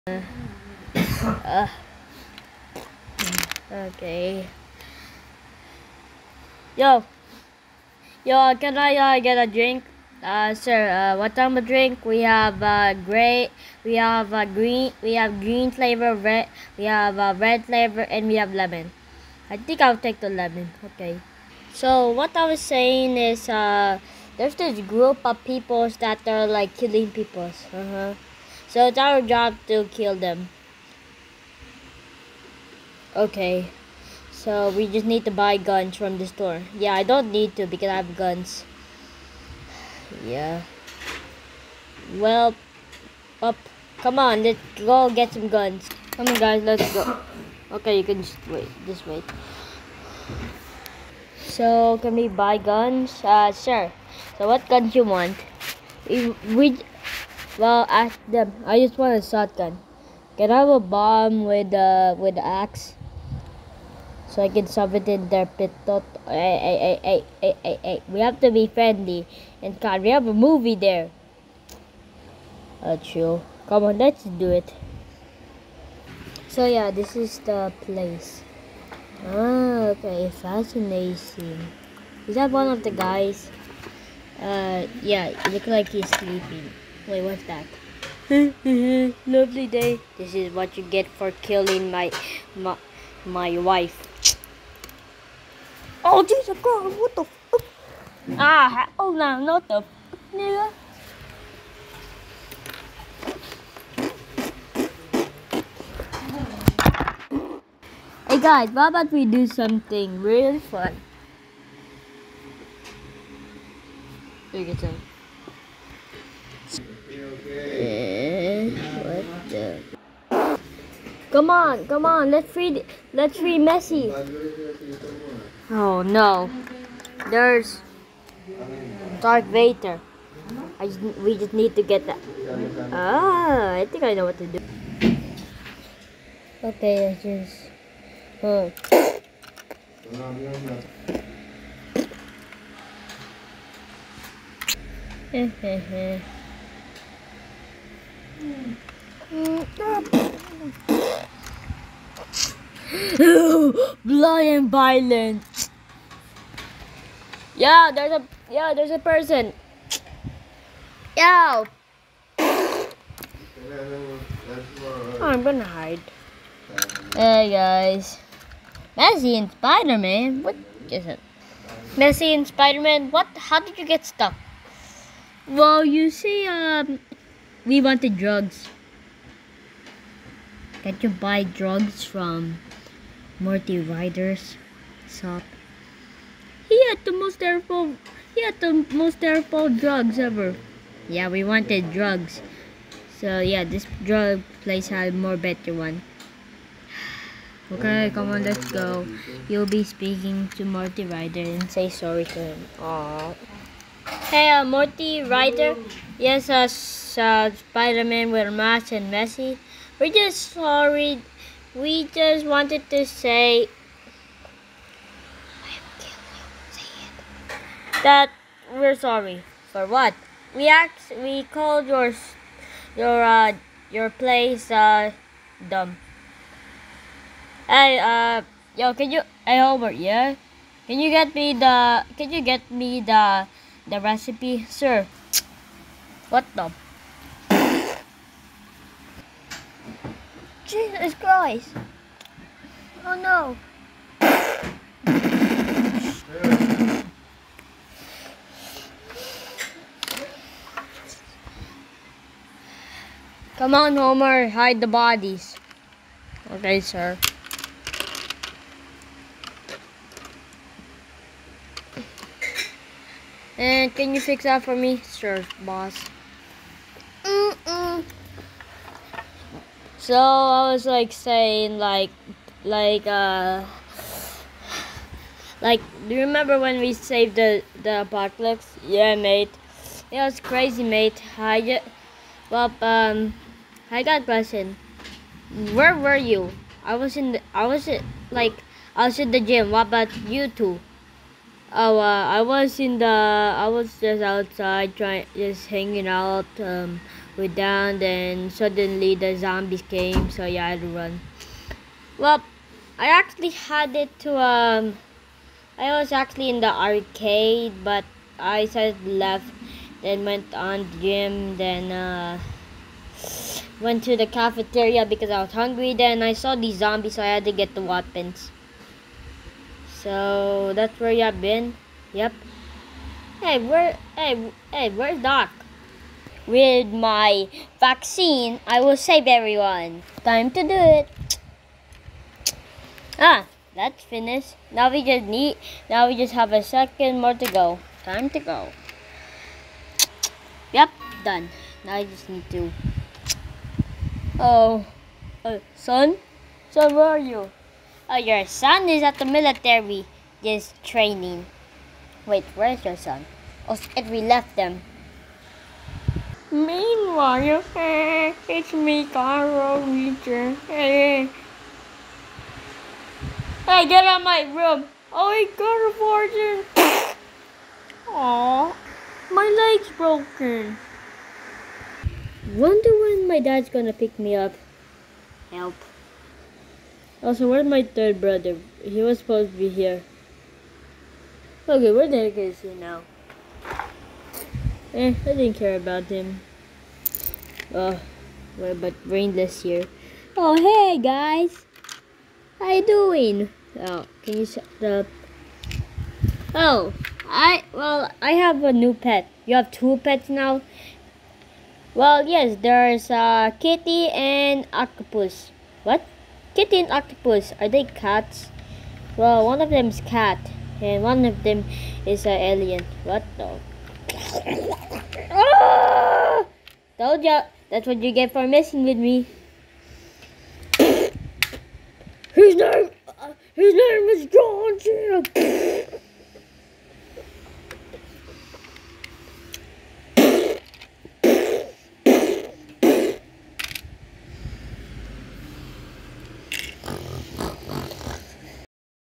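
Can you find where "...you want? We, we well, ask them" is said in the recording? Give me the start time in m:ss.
0:54.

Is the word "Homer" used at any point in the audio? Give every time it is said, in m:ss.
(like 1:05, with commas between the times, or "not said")
4:13.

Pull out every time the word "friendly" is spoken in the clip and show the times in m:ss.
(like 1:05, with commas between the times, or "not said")
1:08.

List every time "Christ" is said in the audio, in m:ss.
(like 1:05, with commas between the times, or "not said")
1:36, 4:01.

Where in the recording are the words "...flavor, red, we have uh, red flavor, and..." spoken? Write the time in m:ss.
0:15.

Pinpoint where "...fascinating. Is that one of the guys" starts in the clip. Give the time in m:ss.
1:20.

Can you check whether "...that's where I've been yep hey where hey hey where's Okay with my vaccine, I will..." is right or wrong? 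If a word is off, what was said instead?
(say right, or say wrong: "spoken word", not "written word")
wrong: "Doc", not "Okay".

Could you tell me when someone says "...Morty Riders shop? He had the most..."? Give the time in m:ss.
3:03.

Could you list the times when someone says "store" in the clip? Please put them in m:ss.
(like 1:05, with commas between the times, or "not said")
0:36.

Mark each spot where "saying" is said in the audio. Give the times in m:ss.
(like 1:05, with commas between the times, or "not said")
0:22, 4:31.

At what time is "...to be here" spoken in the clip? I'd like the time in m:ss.
6:19.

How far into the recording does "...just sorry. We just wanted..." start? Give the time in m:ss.
3:30.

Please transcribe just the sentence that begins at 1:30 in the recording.
This is what you get for killing my my, my wife.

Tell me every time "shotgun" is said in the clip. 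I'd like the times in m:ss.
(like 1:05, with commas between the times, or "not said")
0:59.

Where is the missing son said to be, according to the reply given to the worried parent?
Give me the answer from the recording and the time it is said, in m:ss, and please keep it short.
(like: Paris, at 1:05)
The military, at 5:48.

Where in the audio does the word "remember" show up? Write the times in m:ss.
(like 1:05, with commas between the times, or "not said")
4:36.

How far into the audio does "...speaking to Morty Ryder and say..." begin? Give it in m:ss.
3:19.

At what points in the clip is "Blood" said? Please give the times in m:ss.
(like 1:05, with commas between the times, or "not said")
2:34.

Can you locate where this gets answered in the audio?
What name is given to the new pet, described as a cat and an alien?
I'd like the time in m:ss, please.
7:03.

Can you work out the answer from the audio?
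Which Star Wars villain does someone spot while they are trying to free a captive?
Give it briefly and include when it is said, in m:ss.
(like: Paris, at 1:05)
Dark Vader, at 2:05.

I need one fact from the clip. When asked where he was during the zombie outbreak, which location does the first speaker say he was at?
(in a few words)
The gym.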